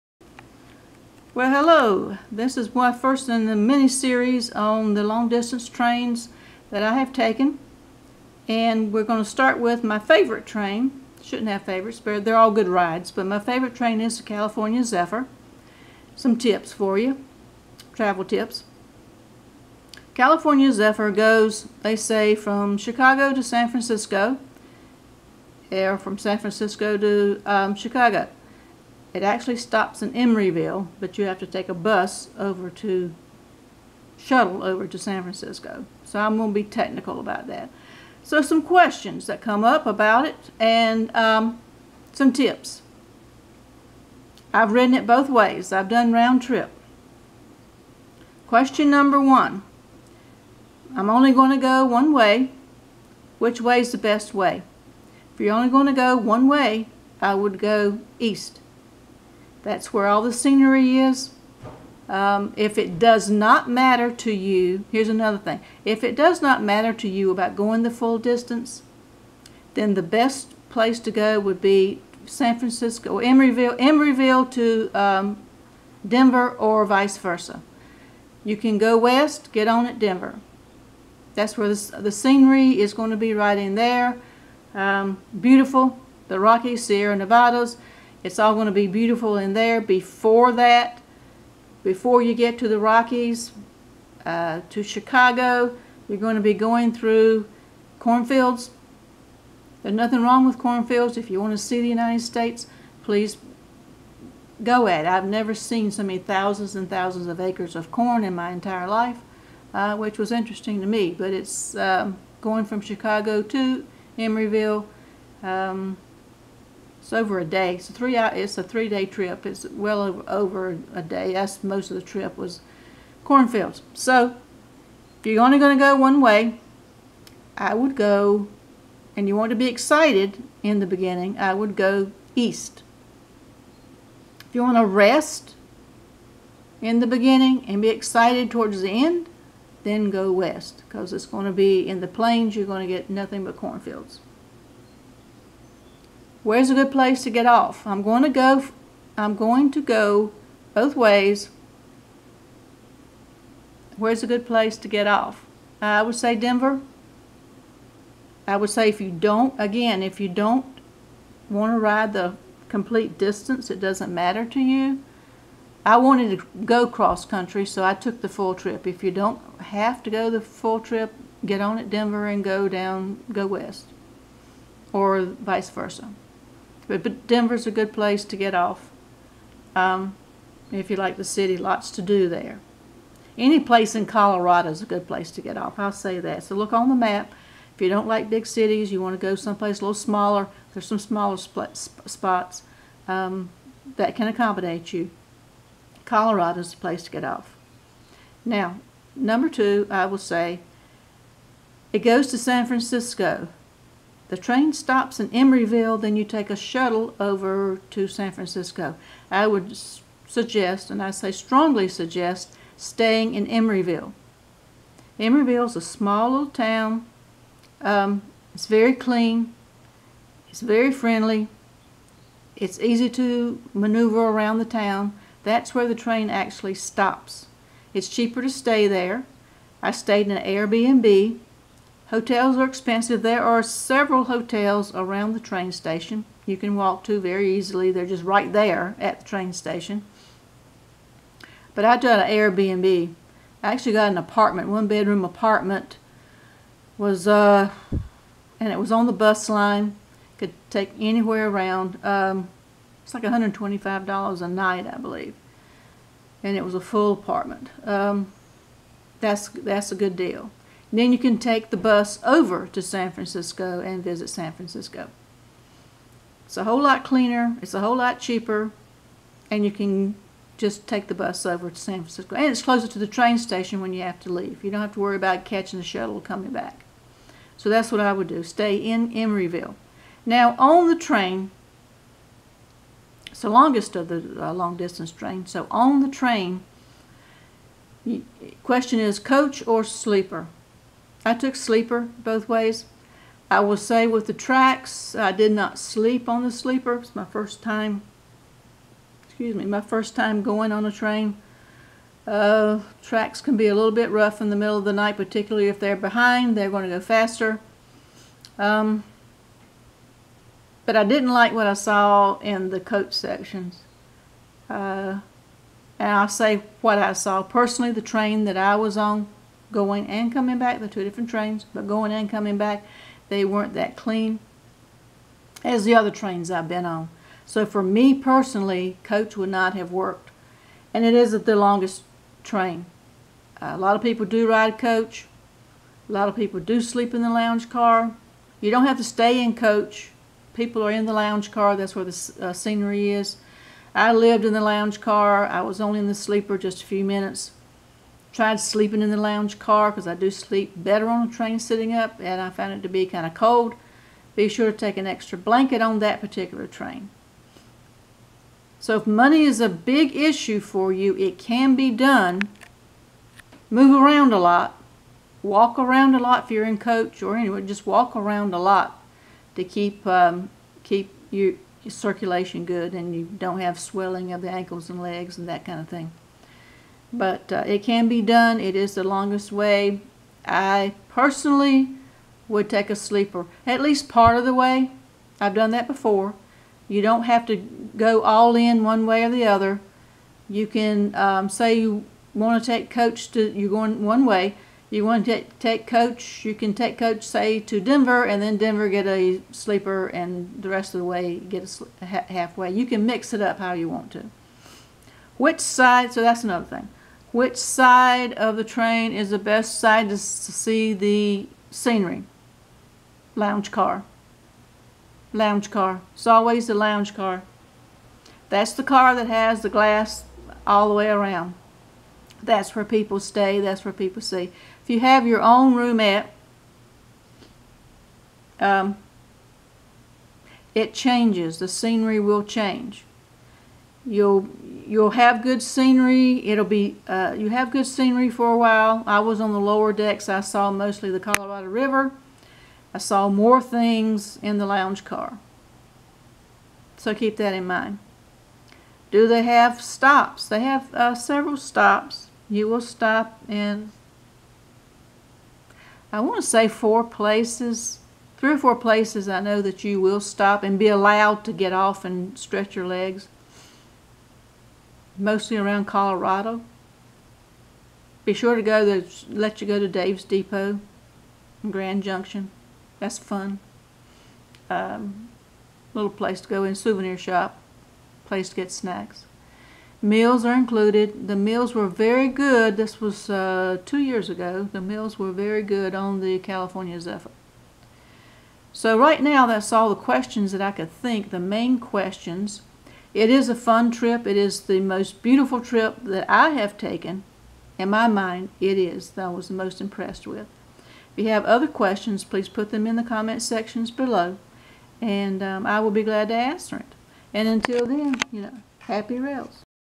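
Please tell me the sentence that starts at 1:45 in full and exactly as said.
I've never seen so many thousands and thousands of acres of corn in my entire life, uh, which was interesting to me.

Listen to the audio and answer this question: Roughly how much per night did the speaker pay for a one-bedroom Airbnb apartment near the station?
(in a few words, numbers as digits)
$125.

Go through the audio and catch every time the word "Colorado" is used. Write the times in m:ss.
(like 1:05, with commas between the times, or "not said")
3:04, 3:16, 7:21, 7:45.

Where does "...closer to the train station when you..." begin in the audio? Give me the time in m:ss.
4:32.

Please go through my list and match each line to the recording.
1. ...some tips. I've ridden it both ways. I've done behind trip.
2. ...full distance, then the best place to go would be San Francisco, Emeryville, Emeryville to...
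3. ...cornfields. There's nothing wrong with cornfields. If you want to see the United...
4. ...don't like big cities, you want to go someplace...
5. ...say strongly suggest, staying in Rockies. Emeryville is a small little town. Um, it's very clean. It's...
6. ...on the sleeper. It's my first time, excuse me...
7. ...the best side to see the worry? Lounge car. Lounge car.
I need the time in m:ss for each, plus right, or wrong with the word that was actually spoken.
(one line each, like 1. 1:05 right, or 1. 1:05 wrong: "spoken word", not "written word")
1. 0:42 wrong: "round", not "behind"
2. 1:07 right
3. 1:37 right
4. 3:07 right
5. 3:31 wrong: "Emeryville", not "Rockies"
6. 4:56 right
7. 6:49 wrong: "scenery", not "worry".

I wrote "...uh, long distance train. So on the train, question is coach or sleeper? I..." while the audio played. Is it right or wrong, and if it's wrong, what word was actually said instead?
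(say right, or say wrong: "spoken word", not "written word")
right.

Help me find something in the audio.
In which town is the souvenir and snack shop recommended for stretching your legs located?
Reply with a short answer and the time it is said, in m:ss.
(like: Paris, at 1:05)
Grand Junction, at 7:51.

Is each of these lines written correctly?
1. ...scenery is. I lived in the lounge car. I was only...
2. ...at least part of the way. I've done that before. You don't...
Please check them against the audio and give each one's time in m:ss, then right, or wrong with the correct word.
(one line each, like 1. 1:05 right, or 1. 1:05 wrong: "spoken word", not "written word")
1. 5:42 right
2. 6:23 right.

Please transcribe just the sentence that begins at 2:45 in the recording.
I wanted to go cross country, so I took the full trip.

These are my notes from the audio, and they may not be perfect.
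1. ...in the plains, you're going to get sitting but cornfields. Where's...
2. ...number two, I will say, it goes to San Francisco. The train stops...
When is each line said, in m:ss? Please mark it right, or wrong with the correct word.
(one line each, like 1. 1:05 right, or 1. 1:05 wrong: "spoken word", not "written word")
1. 2:21 wrong: "nothing", not "sitting"
2. 3:19 right.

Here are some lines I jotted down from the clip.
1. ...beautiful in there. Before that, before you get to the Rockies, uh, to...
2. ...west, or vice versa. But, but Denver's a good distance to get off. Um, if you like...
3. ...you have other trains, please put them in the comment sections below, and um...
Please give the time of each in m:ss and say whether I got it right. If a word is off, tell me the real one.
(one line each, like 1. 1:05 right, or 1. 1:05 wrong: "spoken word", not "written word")
1. 1:28 right
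2. 2:53 wrong: "place", not "distance"
3. 8:21 wrong: "questions", not "trains".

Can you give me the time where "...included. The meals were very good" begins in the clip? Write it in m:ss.
8:00.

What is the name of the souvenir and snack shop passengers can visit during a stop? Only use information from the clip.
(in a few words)
Dave's Depot.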